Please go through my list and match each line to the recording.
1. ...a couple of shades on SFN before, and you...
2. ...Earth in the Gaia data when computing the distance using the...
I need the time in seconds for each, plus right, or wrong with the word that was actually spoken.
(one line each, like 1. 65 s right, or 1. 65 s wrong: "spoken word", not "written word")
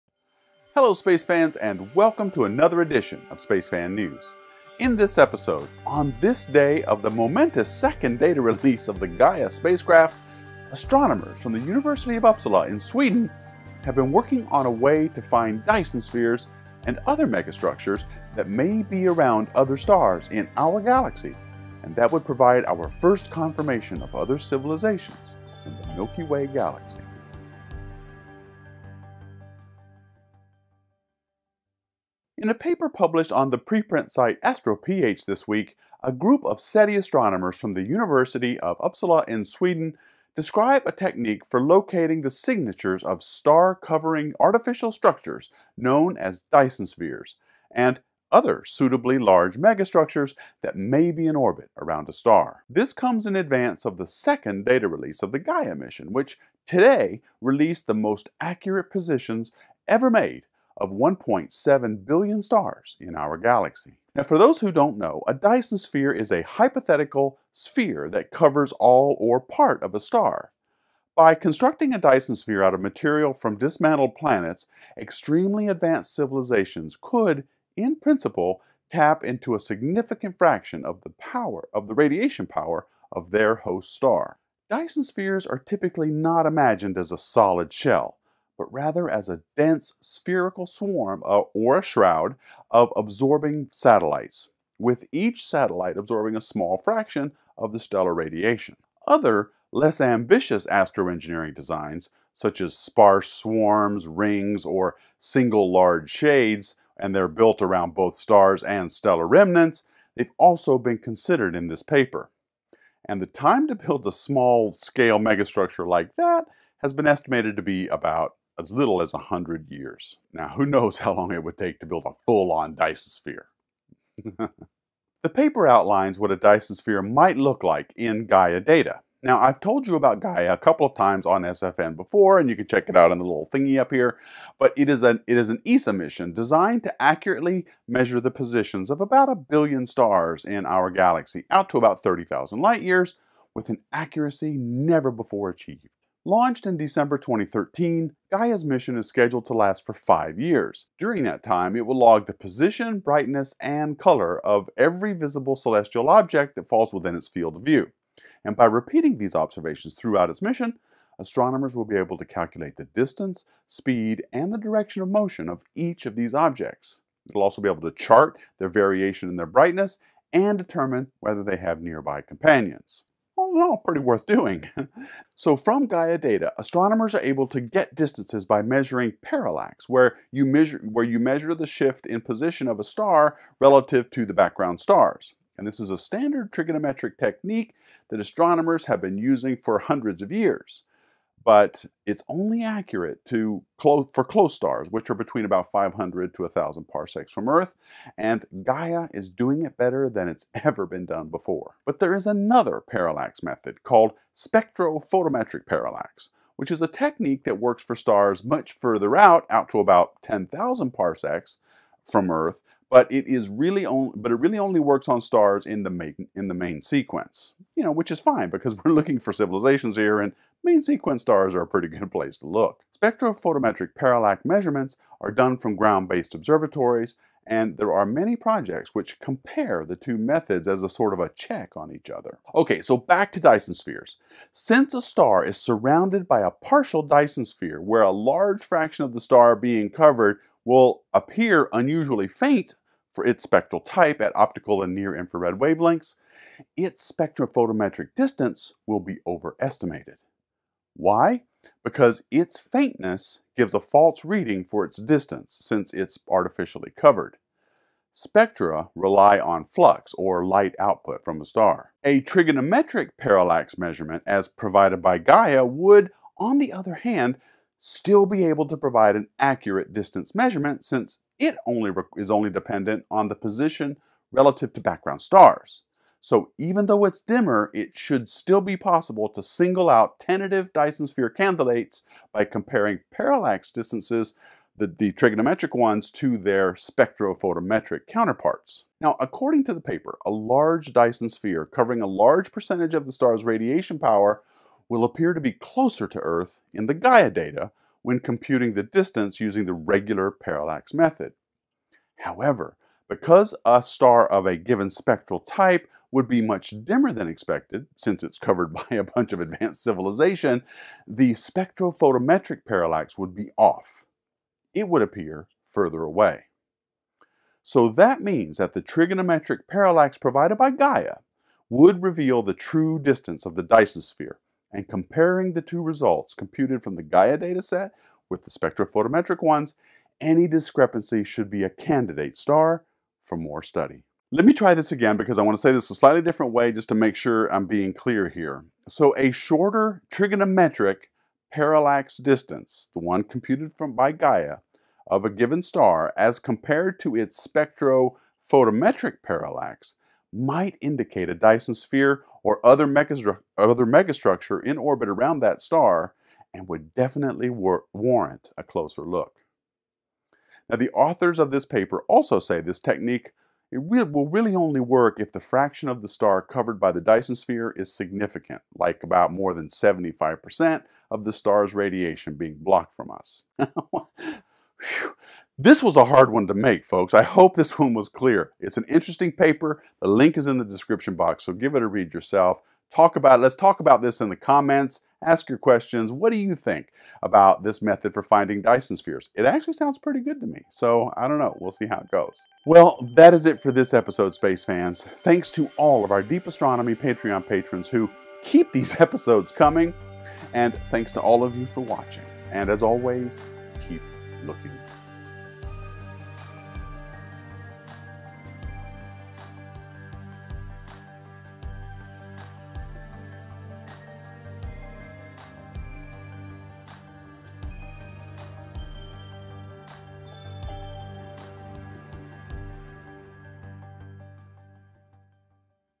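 1. 130 s wrong: "times", not "shades"
2. 296 s right.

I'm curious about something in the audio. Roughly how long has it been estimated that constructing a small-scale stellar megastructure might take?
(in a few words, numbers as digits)
100 years.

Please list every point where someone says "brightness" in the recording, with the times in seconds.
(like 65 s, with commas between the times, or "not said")
152 s, 169 s.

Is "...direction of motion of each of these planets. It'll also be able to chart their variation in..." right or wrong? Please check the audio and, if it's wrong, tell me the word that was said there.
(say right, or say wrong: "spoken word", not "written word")
wrong: "objects", not "planets".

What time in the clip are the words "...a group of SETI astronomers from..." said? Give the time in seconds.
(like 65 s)
36 s.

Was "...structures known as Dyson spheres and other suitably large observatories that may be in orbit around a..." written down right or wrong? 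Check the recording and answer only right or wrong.
wrong.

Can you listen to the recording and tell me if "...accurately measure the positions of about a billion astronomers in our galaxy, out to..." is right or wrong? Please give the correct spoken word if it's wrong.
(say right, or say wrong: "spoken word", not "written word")
wrong: "stars", not "astronomers".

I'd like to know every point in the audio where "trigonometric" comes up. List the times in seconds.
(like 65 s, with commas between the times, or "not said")
186 s, 262 s, 285 s, 318 s, 340 s.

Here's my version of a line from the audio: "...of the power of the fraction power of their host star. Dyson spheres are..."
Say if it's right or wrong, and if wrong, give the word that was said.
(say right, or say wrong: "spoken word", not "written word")
wrong: "radiation", not "fraction".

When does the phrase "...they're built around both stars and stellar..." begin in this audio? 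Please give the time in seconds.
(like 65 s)
107 s.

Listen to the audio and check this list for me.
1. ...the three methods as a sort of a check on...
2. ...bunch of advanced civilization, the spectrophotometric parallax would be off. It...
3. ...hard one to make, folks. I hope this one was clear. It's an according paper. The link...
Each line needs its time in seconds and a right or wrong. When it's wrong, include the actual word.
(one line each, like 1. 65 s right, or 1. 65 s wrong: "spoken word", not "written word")
1. 229 s wrong: "two", not "three"
2. 309 s right
3. 376 s wrong: "interesting", not "according".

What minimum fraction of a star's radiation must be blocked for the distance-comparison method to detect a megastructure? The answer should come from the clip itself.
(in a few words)
75%.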